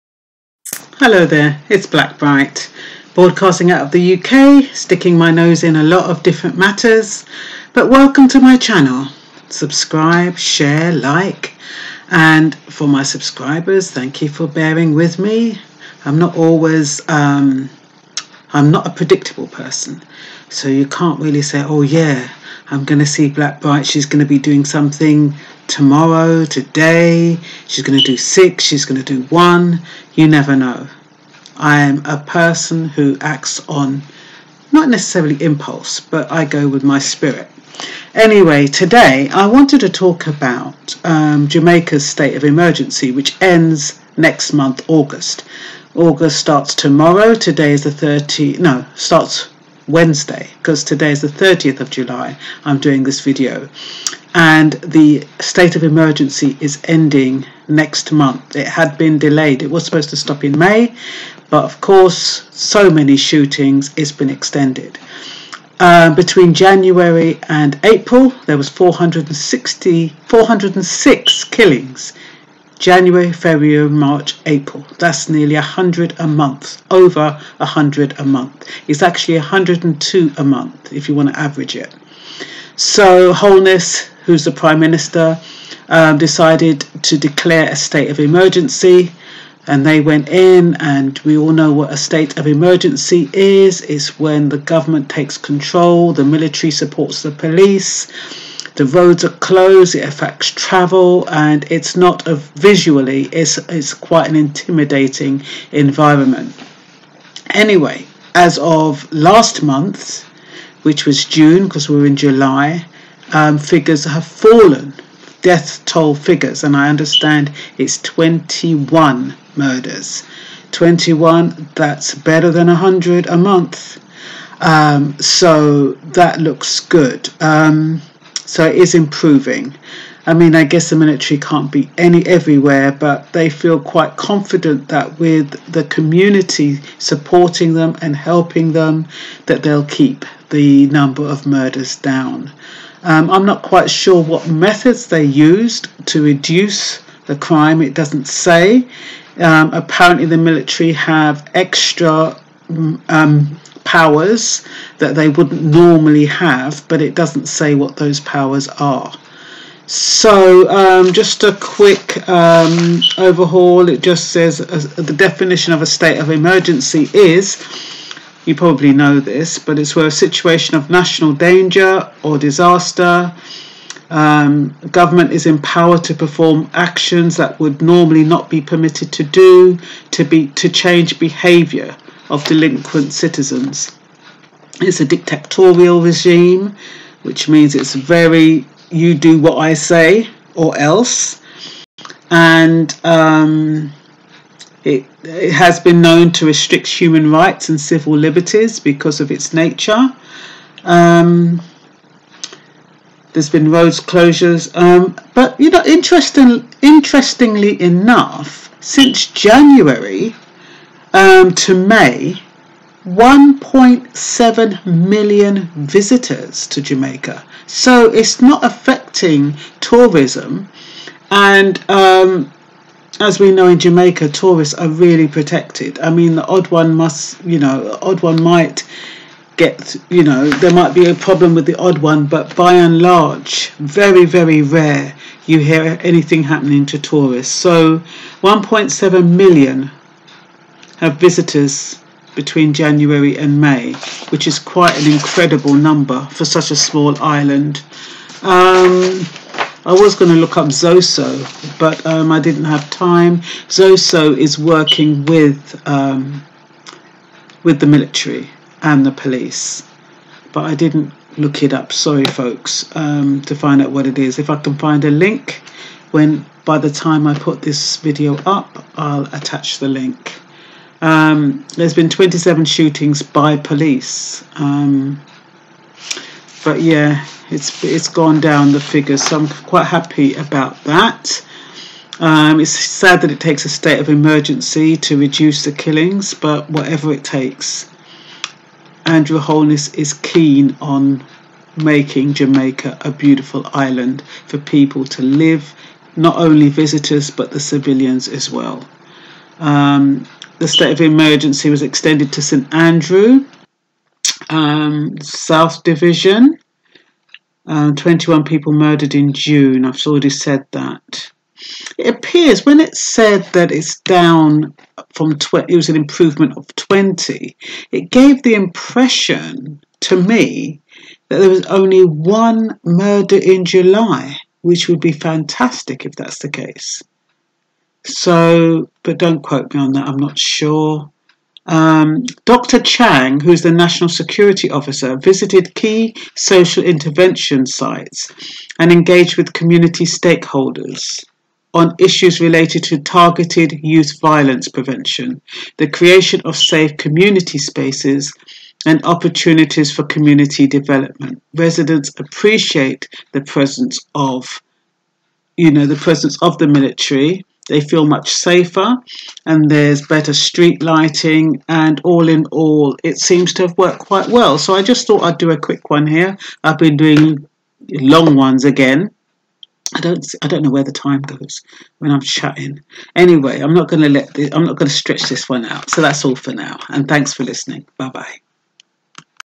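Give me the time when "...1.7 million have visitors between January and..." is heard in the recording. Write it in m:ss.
3:58.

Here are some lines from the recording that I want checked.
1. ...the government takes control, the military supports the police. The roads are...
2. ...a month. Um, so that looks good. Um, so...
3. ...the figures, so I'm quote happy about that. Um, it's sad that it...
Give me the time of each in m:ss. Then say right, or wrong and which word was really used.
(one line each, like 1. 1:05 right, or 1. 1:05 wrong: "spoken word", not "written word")
1. 1:34 right
2. 2:03 right
3. 4:38 wrong: "quite", not "quote".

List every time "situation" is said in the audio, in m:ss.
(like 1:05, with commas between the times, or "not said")
2:50.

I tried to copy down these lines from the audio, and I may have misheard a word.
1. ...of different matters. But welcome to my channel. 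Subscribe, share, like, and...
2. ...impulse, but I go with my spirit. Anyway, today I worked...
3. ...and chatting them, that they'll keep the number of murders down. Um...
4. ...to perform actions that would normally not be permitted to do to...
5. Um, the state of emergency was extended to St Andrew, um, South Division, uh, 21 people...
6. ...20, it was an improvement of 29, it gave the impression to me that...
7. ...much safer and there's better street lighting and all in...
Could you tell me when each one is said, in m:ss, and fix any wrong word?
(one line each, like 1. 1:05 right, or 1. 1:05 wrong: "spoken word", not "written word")
1. 0:06 right
2. 0:35 wrong: "wanted", not "worked"
3. 2:18 wrong: "helping", not "chatting"
4. 2:56 right
5. 4:59 right
6. 5:15 wrong: "20", not "29"
7. 5:58 right.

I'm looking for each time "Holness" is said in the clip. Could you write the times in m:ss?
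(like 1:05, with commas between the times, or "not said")
1:23, 4:49.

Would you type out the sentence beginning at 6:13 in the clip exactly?
Anyway, I'm not going to let this, I'm not going to stretch this one out.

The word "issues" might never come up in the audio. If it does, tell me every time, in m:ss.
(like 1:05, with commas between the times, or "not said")
5:41.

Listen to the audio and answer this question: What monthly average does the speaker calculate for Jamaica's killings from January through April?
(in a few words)
102.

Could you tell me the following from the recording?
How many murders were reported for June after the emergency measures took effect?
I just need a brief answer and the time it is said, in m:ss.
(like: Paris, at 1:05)
21, at 1:58.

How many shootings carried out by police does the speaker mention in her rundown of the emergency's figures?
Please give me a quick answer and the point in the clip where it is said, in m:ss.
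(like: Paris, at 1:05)
27, at 4:32.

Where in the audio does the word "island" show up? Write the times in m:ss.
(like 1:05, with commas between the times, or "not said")
4:07, 4:53.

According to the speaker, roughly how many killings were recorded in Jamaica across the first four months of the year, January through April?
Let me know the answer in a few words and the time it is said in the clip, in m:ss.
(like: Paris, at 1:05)
406, at 1:10.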